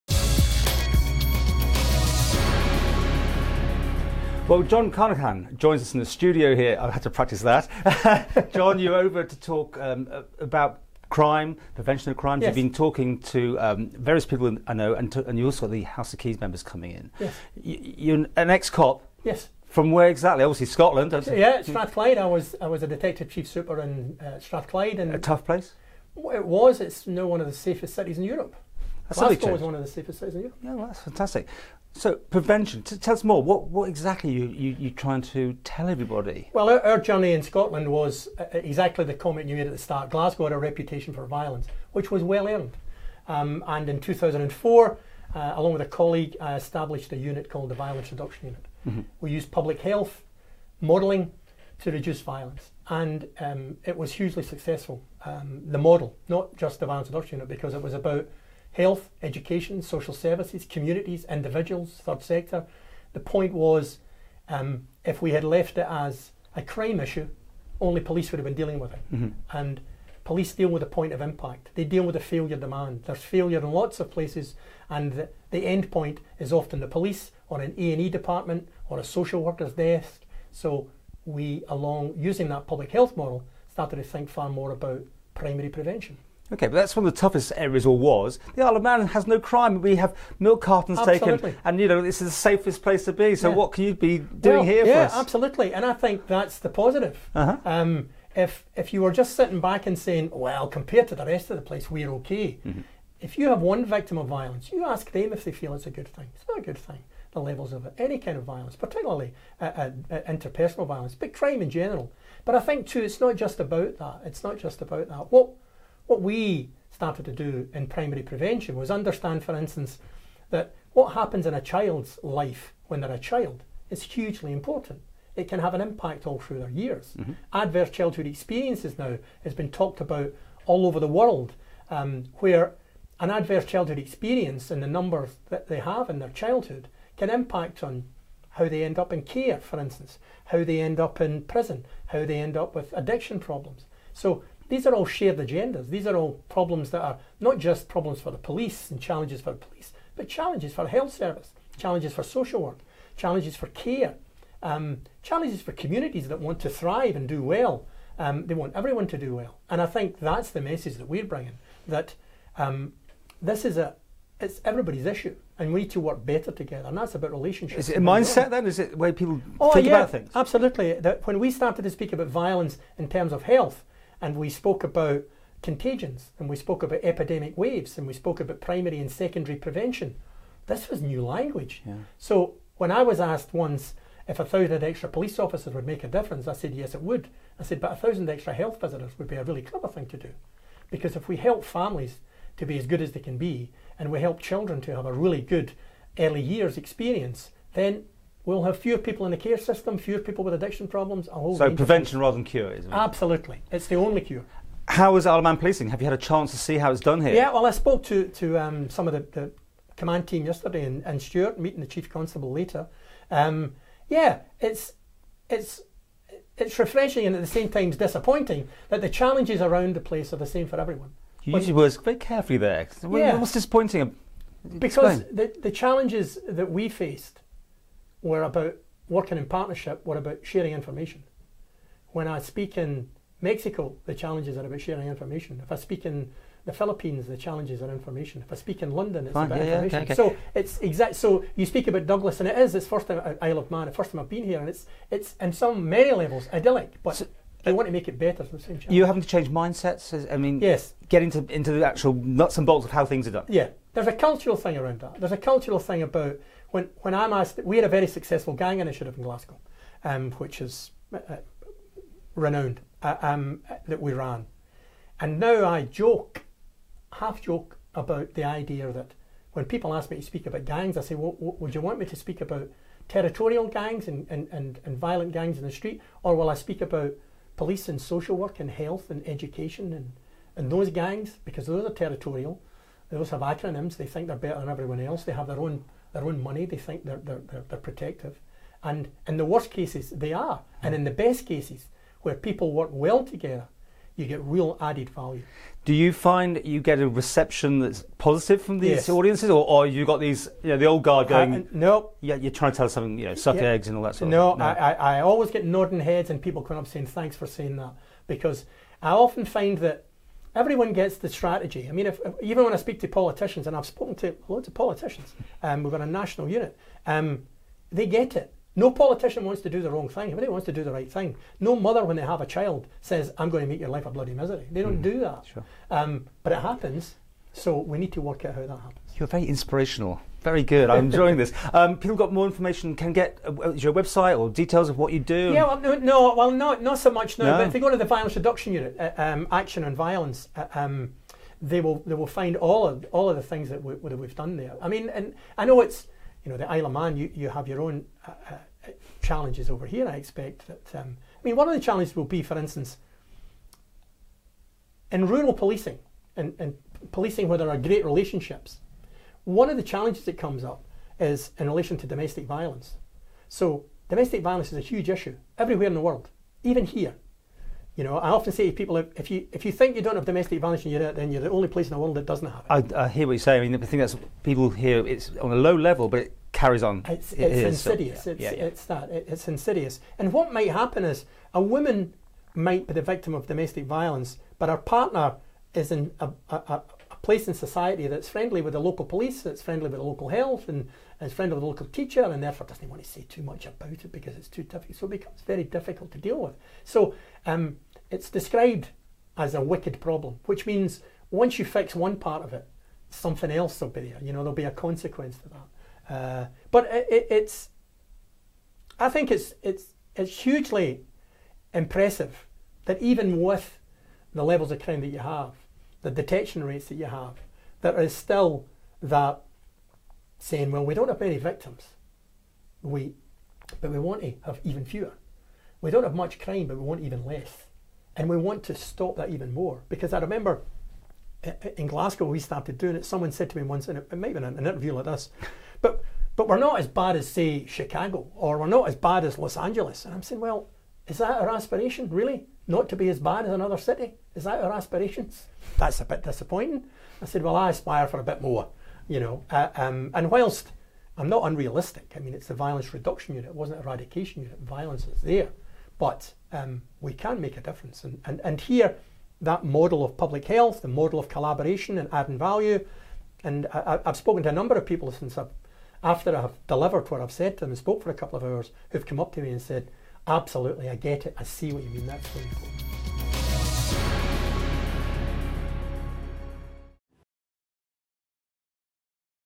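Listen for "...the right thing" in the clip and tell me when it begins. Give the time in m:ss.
5:20.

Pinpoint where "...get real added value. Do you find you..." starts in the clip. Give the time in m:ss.
4:54.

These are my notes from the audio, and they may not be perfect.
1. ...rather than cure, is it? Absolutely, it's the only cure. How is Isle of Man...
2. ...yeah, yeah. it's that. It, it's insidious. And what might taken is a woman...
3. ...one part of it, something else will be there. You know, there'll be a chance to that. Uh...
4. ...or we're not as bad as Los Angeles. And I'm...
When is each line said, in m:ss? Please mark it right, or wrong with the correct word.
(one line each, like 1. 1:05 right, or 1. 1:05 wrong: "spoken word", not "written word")
1. 3:22 right
2. 6:18 wrong: "happen", not "taken"
3. 6:41 wrong: "consequence", not "chance"
4. 7:18 right.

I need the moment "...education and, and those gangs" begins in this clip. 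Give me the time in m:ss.
4:39.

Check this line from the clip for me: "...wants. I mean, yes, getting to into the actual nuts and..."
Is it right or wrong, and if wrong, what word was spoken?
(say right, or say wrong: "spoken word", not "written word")
wrong: "mindsets", not "wants".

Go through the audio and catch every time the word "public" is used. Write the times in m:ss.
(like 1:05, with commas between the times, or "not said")
0:49, 1:22, 7:40.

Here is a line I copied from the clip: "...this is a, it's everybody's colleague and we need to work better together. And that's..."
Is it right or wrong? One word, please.
wrong.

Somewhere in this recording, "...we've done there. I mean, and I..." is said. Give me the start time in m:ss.
5:44.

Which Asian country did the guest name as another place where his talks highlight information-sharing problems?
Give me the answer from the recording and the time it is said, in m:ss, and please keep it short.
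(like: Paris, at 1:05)
The Philippines, at 3:56.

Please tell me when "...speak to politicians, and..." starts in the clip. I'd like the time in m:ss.
5:12.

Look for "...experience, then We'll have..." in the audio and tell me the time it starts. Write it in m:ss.
3:16.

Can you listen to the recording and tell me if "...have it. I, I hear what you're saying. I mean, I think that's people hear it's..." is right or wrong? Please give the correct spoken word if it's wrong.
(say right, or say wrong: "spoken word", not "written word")
right.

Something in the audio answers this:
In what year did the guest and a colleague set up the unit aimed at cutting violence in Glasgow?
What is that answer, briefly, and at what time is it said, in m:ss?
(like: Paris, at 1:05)
2004, at 0:43.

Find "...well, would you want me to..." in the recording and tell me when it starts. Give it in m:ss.
4:31.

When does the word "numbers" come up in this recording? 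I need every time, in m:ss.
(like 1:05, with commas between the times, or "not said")
2:14, 7:44.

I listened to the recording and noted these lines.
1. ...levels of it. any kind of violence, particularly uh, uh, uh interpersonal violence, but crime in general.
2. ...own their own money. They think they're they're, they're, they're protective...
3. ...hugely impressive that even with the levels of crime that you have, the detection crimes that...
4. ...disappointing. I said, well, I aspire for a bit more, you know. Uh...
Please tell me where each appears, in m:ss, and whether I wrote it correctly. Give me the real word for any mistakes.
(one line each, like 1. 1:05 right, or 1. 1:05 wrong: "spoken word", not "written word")
1. 1:47 right
2. 4:45 right
3. 6:50 wrong: "rates", not "crimes"
4. 7:26 right.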